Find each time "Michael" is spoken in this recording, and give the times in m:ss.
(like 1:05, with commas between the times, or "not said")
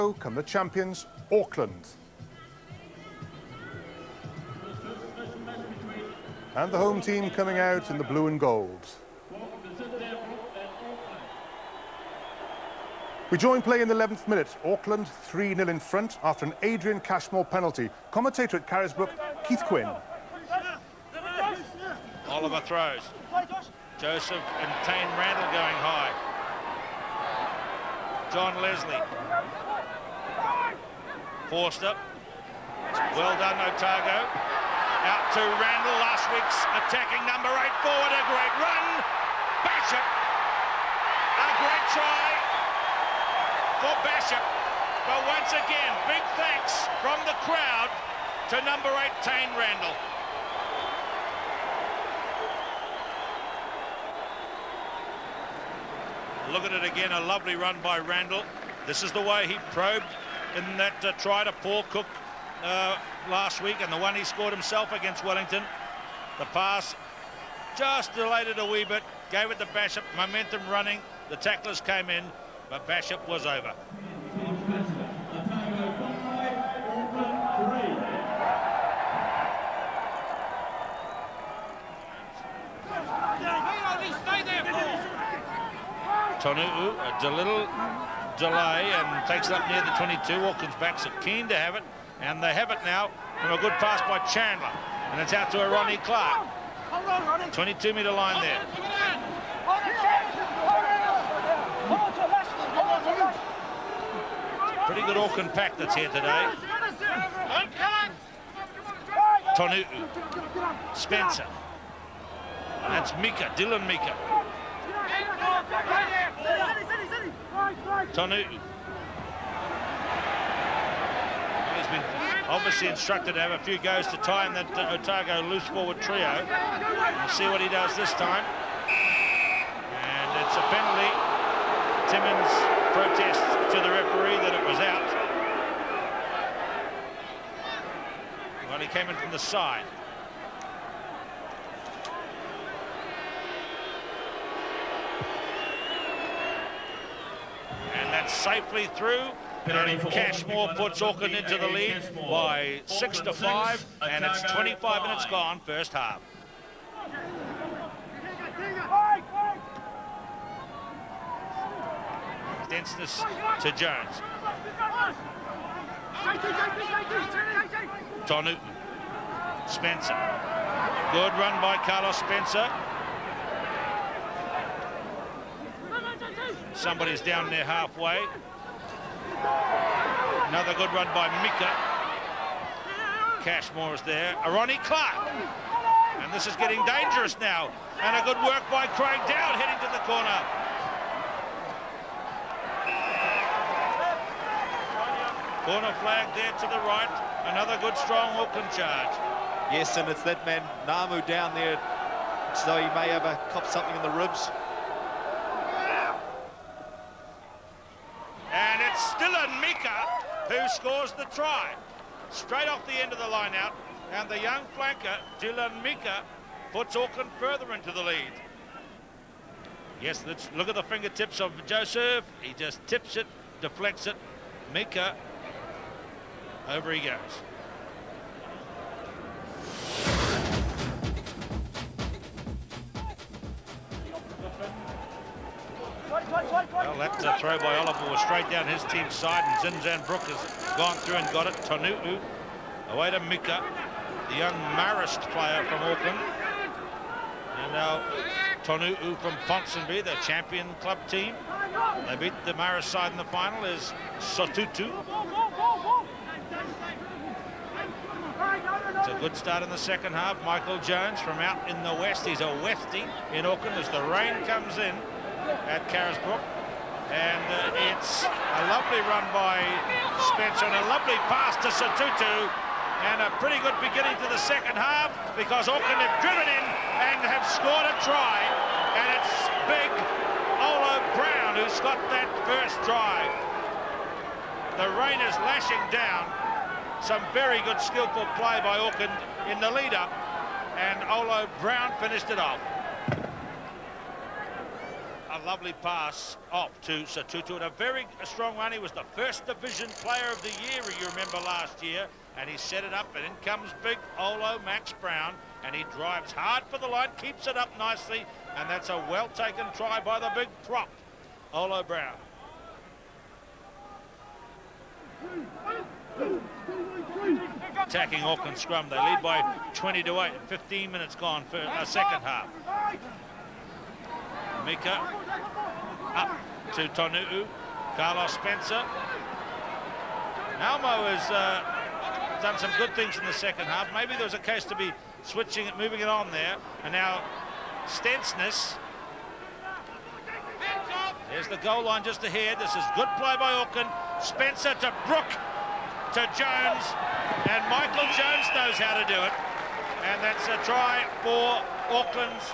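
4:20, 5:47.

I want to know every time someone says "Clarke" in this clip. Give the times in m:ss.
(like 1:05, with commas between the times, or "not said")
1:36, 3:04.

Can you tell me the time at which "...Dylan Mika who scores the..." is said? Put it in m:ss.
3:29.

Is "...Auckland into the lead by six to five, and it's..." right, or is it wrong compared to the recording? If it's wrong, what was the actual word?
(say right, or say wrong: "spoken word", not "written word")
right.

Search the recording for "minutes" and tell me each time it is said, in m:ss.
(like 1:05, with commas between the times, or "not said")
0:14, 2:35, 5:20.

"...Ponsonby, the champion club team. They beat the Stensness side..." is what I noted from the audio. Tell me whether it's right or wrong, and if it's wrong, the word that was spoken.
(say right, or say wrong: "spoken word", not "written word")
wrong: "Marist", not "Stensness".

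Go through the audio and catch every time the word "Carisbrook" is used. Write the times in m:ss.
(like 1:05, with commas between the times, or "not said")
0:18, 4:25.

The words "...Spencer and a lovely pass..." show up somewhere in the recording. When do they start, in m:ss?
4:30.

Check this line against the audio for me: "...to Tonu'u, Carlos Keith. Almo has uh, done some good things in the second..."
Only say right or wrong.
wrong.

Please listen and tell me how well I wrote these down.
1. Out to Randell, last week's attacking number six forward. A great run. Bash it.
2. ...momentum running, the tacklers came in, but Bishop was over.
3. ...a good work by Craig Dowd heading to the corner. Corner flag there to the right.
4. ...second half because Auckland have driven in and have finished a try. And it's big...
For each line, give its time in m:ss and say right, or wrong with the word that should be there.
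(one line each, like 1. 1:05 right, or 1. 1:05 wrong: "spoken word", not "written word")
1. 0:35 wrong: "eight", not "six"
2. 1:10 right
3. 3:08 right
4. 4:34 wrong: "scored", not "finished".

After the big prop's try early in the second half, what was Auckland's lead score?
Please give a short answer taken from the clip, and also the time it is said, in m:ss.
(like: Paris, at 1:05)
20 to 8, at 5:19.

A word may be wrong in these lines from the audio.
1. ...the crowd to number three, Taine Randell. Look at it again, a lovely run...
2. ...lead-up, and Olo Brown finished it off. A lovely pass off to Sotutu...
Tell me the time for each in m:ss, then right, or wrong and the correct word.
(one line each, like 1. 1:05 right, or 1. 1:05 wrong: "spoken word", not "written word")
1. 0:47 wrong: "eight", not "three"
2. 4:49 right.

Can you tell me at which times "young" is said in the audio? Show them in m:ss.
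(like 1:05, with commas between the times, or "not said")
3:34, 4:04.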